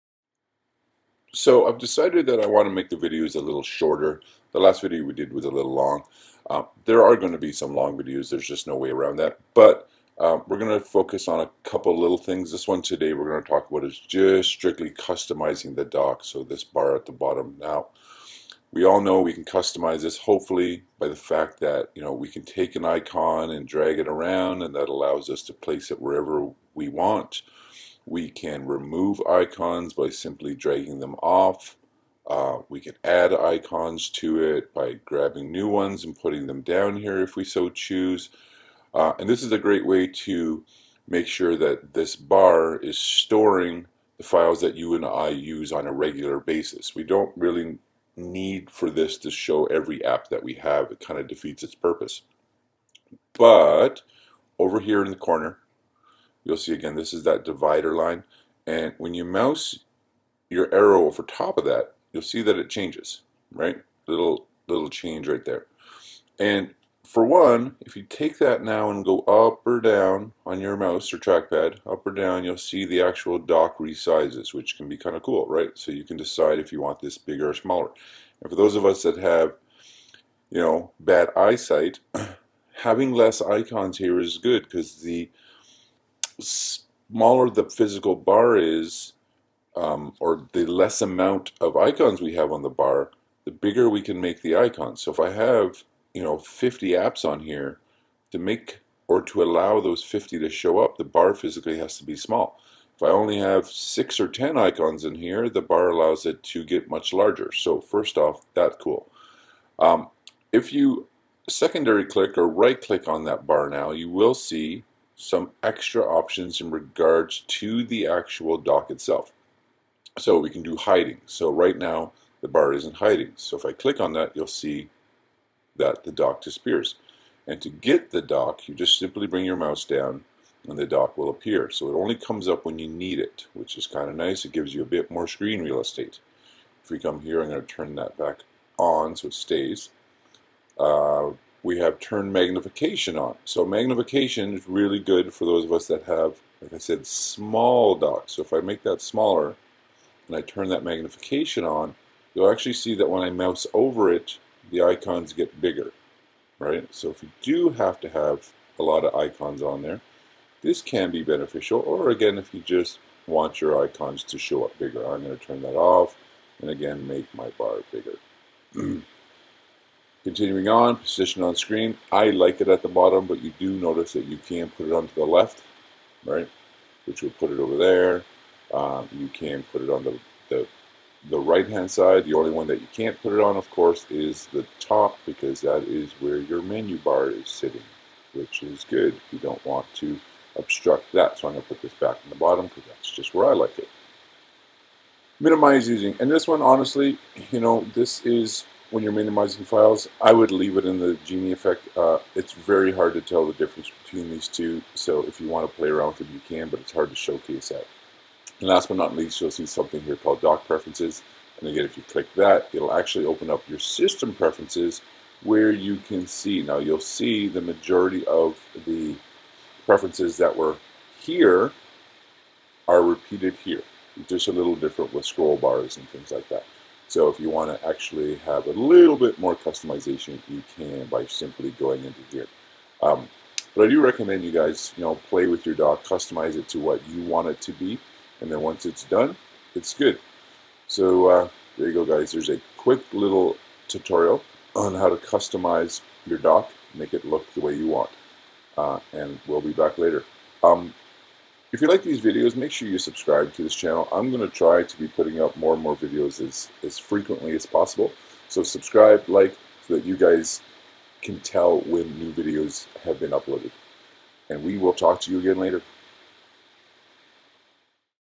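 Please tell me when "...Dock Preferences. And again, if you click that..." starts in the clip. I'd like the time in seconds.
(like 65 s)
210 s.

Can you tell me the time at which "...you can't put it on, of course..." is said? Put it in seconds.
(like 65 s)
182 s.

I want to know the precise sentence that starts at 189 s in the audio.
You don't want to obstruct that.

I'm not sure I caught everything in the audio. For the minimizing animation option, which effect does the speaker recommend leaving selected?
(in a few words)
Genie effect.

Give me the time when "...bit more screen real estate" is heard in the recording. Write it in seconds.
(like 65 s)
134 s.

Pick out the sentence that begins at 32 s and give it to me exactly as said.
Uh, we can add icons to it by grabbing new ones and putting them down here if we so choose.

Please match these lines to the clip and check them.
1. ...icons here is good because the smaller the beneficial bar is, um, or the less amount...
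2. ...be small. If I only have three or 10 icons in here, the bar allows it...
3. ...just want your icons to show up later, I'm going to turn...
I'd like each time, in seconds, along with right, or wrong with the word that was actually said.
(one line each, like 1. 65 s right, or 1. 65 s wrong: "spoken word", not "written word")
1. 83 s wrong: "physical", not "beneficial"
2. 102 s wrong: "six", not "three"
3. 162 s wrong: "bigger", not "later".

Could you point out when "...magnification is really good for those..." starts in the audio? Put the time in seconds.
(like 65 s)
143 s.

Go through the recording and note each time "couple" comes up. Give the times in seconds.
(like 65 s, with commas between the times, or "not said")
11 s.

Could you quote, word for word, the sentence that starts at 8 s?
There's just no way around that.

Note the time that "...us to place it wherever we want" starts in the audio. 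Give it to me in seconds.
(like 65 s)
25 s.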